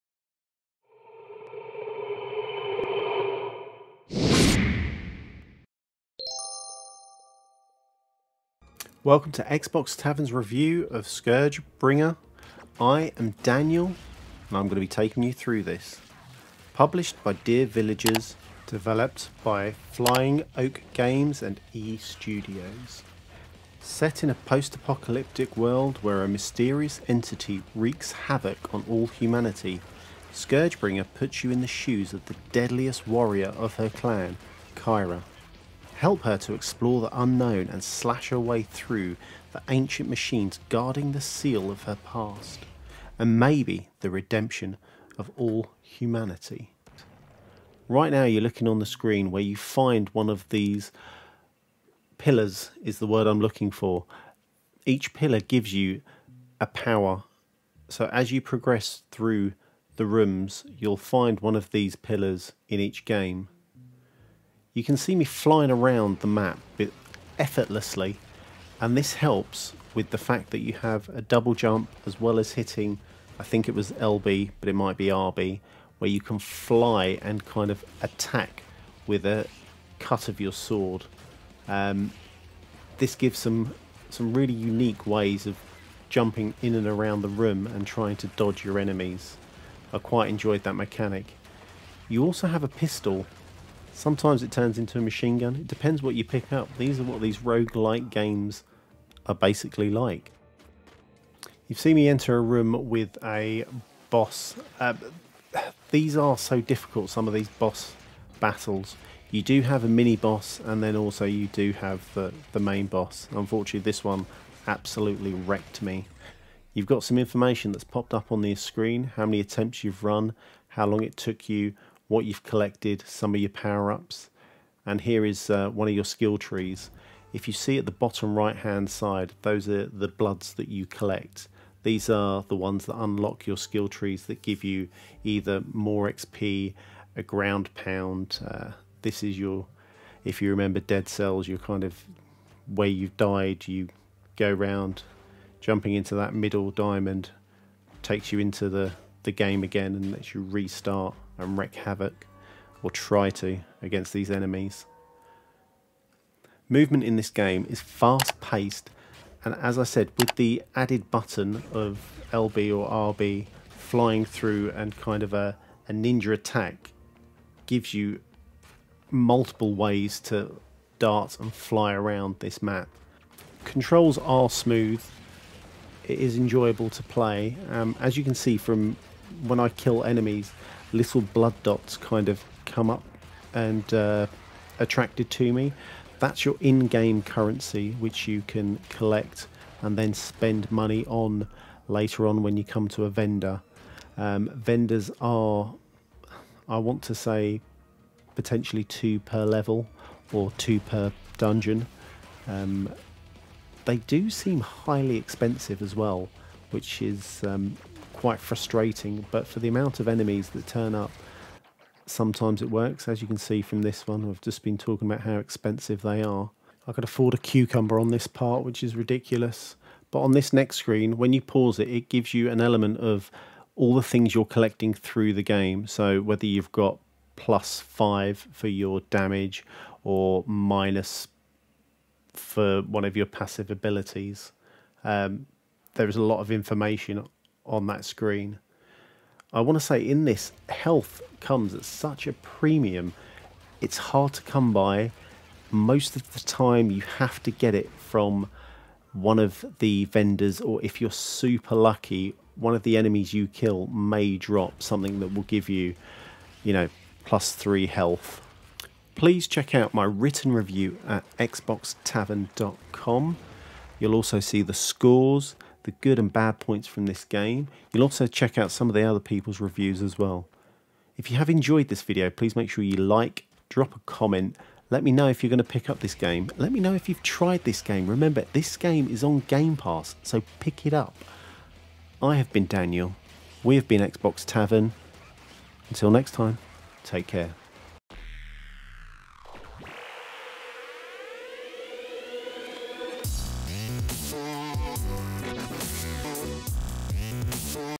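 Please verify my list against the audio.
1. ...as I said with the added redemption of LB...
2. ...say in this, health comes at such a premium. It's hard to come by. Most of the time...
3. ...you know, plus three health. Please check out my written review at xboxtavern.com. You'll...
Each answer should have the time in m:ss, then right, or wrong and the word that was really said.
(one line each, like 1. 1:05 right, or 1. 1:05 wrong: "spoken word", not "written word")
1. 2:39 wrong: "button", not "redemption"
2. 3:59 right
3. 4:16 right.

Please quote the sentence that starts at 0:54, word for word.
Each pillar gives you a power.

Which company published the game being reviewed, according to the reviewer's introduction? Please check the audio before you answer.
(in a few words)
Dear Villagers.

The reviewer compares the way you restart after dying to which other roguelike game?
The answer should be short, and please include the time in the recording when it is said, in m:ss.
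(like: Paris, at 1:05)
Dead Cells, at 2:20.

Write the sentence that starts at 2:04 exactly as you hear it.
And here is uh, one of your skill trees.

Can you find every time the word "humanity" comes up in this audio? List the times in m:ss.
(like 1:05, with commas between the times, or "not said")
0:29, 0:45.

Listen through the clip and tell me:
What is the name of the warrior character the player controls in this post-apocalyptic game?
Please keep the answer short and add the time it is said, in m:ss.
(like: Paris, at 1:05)
Kyhra, at 0:34.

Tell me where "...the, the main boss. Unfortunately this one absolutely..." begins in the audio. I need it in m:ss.
1:52.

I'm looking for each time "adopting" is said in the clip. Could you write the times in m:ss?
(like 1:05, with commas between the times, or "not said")
not said.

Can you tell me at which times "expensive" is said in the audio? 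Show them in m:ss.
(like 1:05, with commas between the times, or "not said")
3:25, 3:35.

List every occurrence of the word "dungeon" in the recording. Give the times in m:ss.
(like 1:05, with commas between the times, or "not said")
3:21.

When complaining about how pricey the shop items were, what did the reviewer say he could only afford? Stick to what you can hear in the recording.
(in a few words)
a cucumber.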